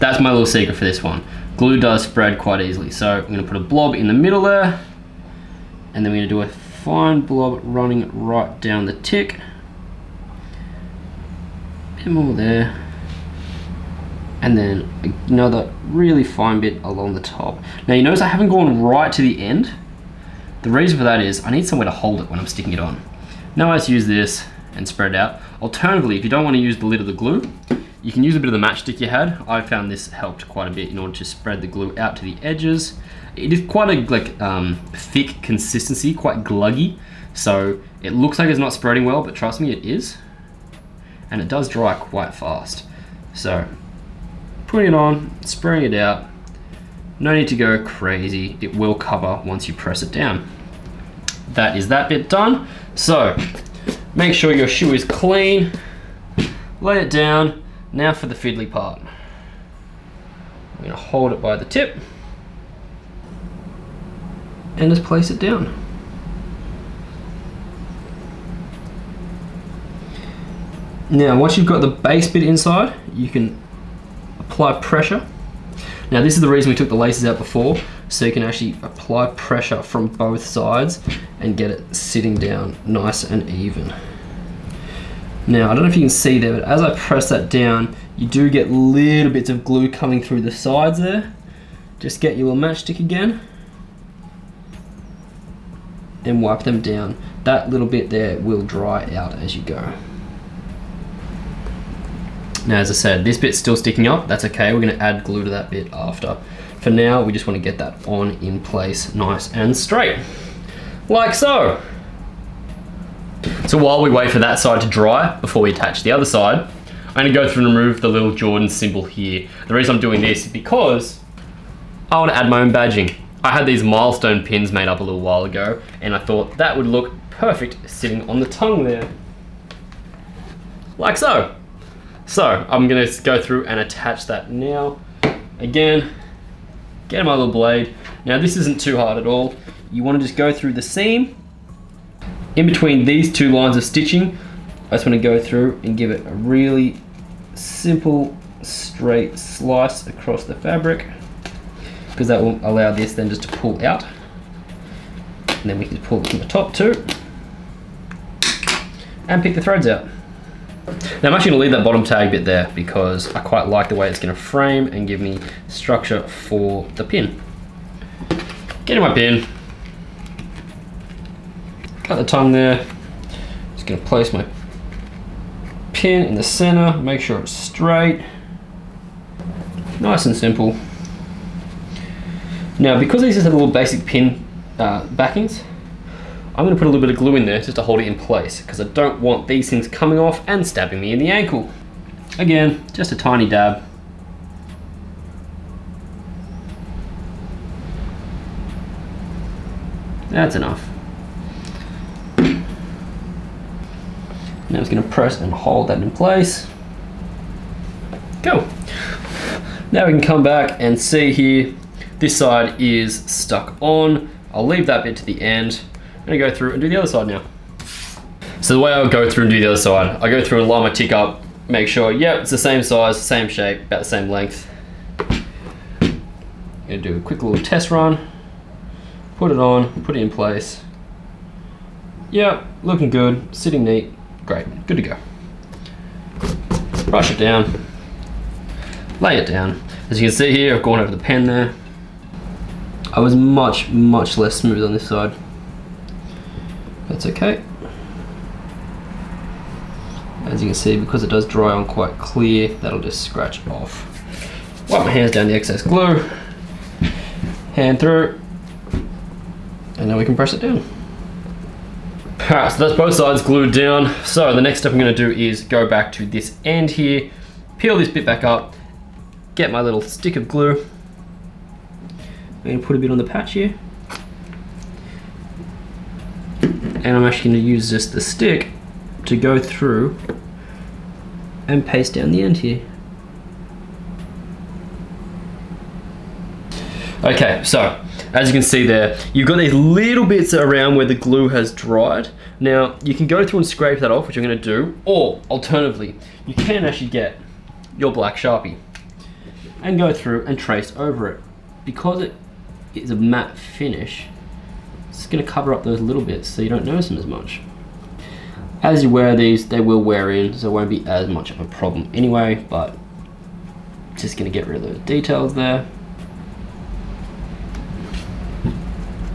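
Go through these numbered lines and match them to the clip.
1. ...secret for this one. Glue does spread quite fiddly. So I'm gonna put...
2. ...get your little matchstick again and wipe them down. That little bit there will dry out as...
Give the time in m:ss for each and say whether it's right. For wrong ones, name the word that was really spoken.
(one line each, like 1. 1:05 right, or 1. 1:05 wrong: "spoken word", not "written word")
1. 0:00 wrong: "easily", not "fiddly"
2. 1:32 right.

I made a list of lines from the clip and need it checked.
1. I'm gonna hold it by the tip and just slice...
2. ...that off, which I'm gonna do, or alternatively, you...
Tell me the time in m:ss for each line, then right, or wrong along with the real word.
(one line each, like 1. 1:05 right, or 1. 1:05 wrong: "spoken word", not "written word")
1. 1:00 wrong: "place", not "slice"
2. 4:53 right.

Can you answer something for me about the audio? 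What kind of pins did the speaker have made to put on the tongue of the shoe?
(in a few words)
milestone pins.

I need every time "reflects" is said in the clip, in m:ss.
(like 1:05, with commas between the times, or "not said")
not said.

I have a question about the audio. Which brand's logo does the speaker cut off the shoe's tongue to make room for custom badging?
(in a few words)
Jordan.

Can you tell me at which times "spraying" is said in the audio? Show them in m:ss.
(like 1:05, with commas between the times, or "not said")
0:45.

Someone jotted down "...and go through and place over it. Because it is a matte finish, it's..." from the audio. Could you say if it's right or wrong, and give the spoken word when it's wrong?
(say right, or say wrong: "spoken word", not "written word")
wrong: "trace", not "place".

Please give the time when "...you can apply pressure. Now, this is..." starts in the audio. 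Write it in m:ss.
1:13.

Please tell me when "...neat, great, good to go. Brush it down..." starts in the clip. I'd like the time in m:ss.
3:53.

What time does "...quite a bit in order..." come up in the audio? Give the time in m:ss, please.
0:30.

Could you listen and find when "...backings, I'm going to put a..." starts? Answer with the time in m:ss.
3:05.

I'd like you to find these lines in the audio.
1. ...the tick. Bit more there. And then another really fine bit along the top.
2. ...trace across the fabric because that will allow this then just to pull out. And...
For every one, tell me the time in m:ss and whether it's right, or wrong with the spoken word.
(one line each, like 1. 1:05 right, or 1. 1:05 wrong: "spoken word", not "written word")
1. 0:08 right
2. 2:29 wrong: "slice", not "trace".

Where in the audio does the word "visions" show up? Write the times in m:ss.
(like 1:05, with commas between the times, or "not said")
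not said.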